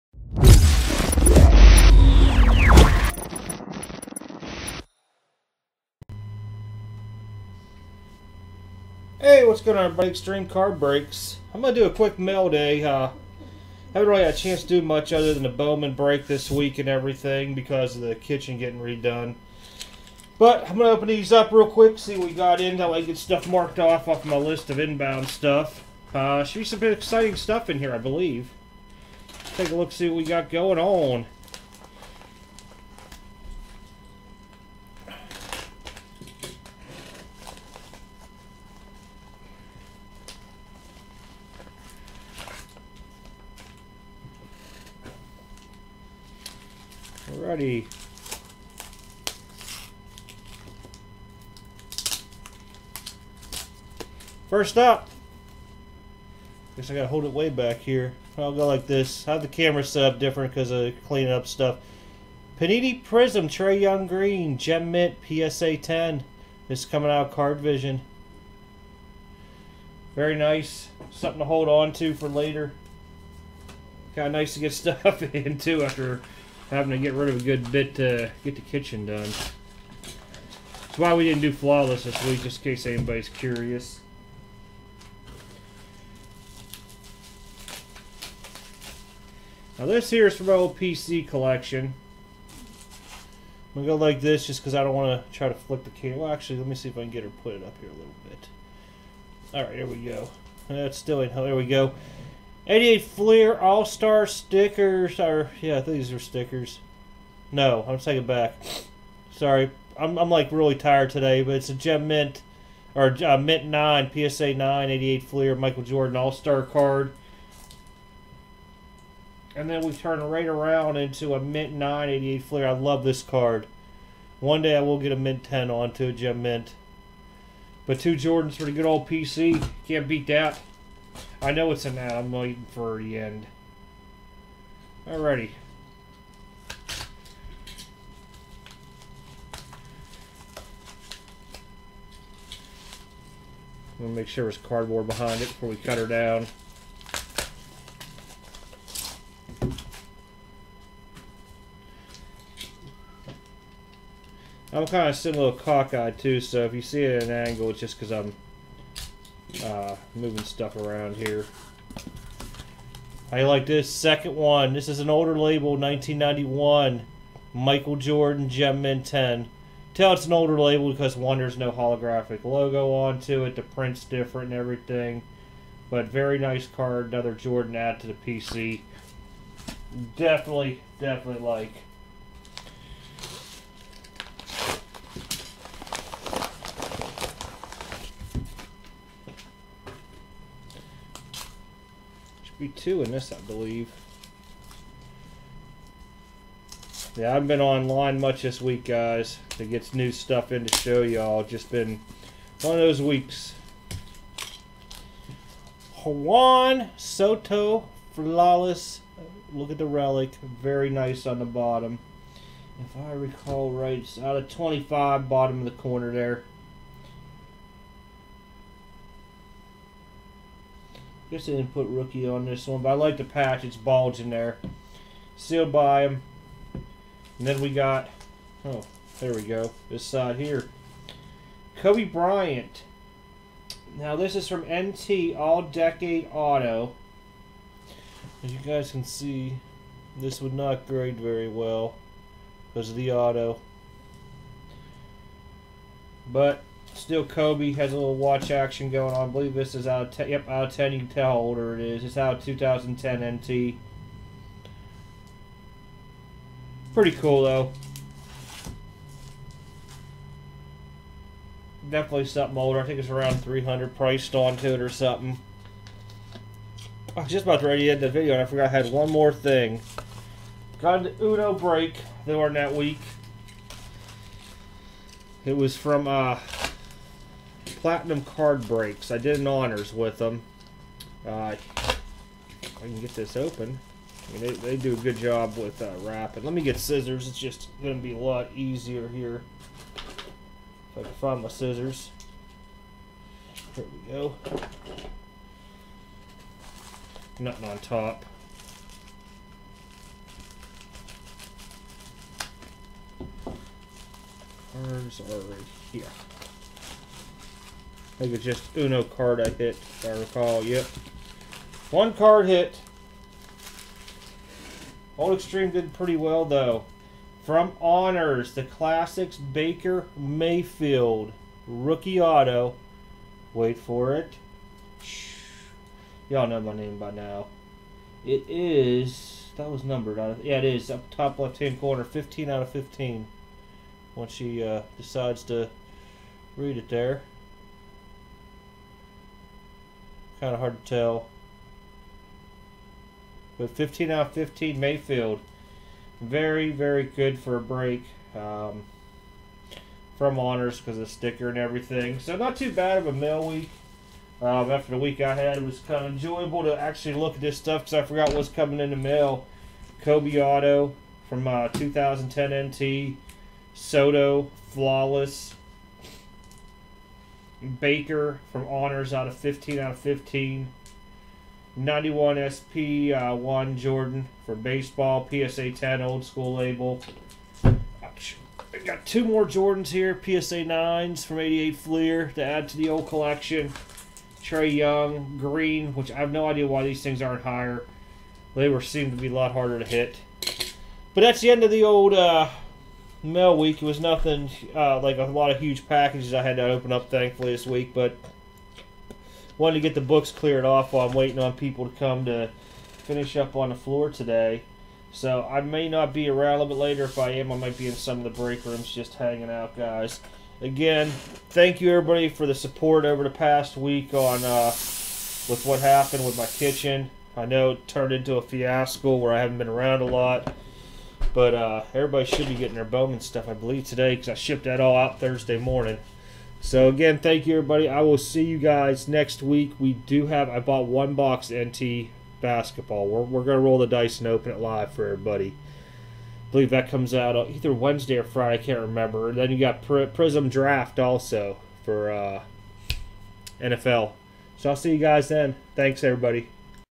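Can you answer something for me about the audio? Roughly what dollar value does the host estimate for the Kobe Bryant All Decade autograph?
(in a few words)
300.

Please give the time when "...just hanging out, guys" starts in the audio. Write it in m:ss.
6:48.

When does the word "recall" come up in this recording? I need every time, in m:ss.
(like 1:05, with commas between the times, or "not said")
3:33, 5:10.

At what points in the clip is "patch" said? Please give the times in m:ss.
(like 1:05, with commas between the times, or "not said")
3:43.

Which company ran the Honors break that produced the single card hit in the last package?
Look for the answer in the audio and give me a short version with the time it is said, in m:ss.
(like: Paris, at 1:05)
Platinum Card Breaks, at 4:37.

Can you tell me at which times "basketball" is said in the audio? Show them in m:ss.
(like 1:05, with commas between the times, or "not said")
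7:12.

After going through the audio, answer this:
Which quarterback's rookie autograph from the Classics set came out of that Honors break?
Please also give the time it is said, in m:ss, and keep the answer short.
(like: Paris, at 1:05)
Baker Mayfield, at 5:19.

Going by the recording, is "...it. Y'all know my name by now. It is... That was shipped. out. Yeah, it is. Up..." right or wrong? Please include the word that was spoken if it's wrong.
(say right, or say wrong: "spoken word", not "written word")
wrong: "numbered", not "shipped".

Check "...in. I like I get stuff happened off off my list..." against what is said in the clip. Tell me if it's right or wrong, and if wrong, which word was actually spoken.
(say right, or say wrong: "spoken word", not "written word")
wrong: "marked", not "happened".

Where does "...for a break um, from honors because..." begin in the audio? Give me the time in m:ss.
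5:47.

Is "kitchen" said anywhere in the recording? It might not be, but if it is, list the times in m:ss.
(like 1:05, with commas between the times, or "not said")
0:18, 1:18, 6:56.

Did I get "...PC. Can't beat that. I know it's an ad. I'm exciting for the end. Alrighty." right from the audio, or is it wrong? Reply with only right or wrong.
wrong.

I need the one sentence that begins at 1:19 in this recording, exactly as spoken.
That's why we didn't do flawless this week, just in case anybody's curious.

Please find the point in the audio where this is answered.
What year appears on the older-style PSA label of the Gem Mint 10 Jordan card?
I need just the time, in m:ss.
2:45.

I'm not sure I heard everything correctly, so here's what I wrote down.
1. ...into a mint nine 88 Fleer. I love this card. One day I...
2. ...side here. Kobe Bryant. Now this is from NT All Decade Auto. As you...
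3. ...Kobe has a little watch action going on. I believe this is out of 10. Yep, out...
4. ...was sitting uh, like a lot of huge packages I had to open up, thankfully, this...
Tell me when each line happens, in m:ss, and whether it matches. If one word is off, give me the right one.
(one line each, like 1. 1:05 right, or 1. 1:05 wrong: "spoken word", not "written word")
1. 2:00 right
2. 3:50 right
3. 4:07 right
4. 6:33 wrong: "nothing", not "sitting".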